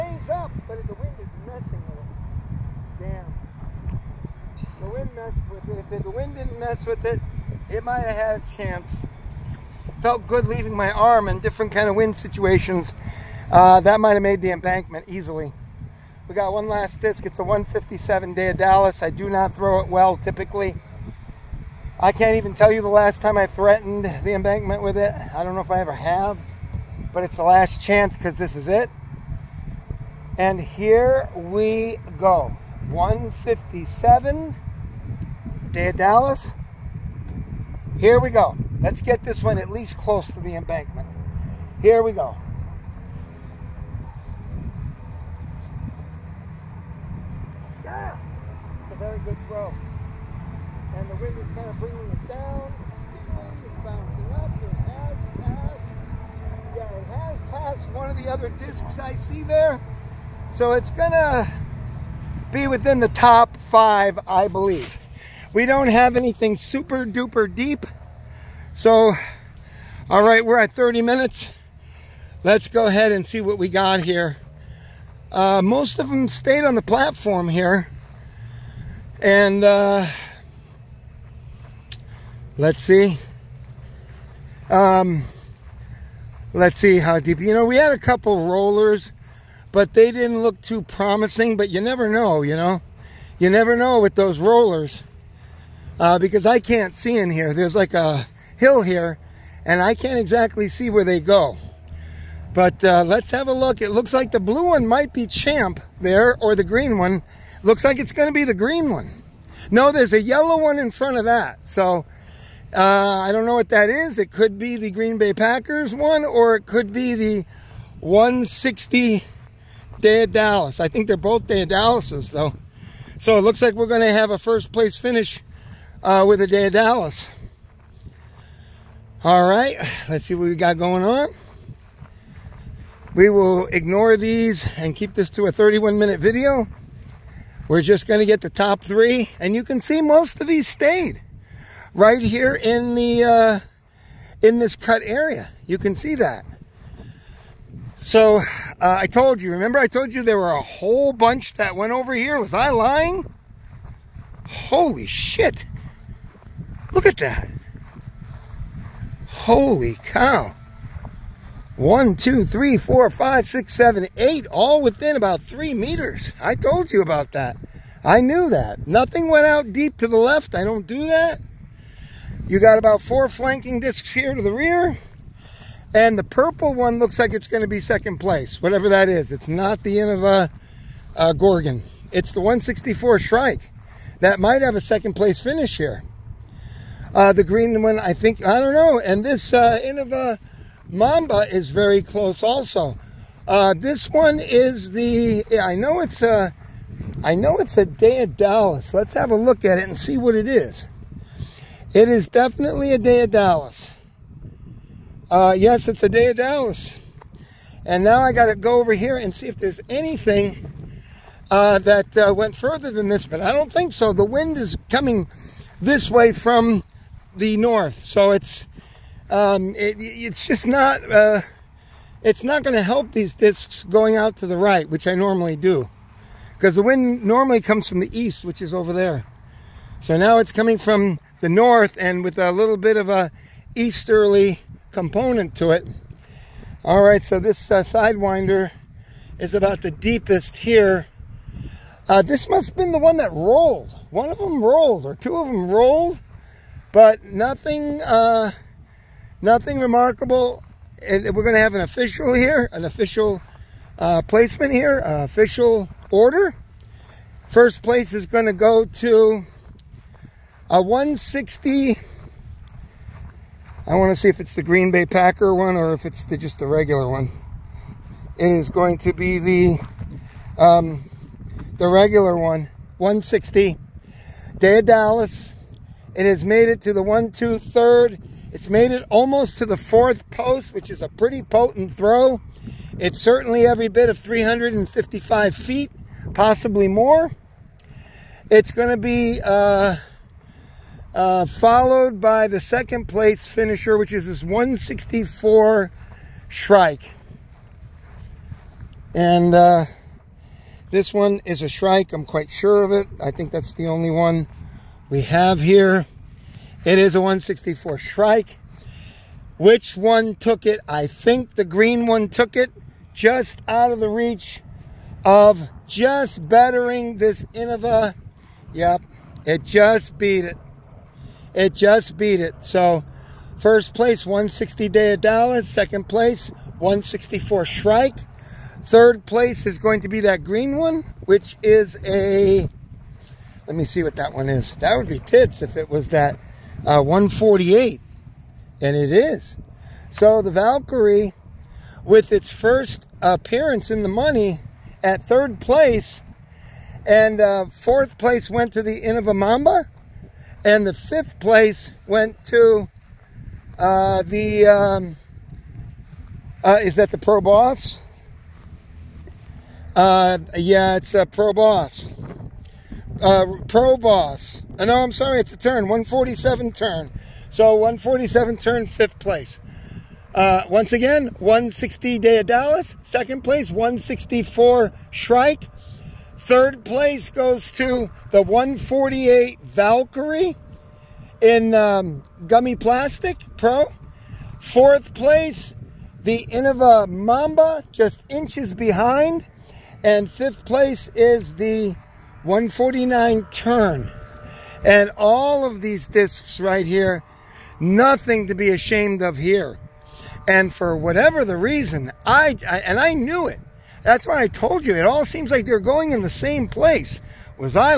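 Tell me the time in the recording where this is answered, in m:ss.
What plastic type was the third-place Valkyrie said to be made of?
6:22.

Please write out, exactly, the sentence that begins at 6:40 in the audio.
And for whatever the reason, I, I and I knew it.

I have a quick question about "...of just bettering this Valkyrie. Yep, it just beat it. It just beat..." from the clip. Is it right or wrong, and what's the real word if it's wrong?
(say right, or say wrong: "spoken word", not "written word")
wrong: "Innova", not "Valkyrie".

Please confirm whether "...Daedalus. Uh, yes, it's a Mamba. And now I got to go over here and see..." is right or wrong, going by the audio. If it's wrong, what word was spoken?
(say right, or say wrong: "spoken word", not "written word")
wrong: "Daedalus", not "Mamba".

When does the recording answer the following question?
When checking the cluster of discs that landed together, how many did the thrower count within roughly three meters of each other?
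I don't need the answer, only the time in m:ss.
2:44.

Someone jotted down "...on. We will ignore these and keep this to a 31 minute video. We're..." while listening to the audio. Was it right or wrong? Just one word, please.
right.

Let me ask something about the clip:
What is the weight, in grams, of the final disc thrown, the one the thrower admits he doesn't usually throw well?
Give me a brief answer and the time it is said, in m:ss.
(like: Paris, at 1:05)
157, at 0:17.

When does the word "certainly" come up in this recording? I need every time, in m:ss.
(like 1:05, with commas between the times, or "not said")
4:43.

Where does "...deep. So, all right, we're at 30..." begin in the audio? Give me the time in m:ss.
1:07.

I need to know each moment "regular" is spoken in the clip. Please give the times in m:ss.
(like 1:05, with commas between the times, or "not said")
4:26, 4:31.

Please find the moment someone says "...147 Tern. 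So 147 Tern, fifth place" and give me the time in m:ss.
6:05.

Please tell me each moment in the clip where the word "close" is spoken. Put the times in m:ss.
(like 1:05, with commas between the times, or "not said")
0:39, 3:12.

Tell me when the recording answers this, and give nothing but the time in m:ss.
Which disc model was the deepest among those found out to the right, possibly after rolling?
3:57.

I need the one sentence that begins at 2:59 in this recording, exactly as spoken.
It's not the Innova uh, uh, Gorgon.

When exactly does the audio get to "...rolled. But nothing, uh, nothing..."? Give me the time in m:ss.
4:05.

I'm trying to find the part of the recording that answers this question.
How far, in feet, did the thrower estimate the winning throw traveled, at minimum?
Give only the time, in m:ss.
4:44.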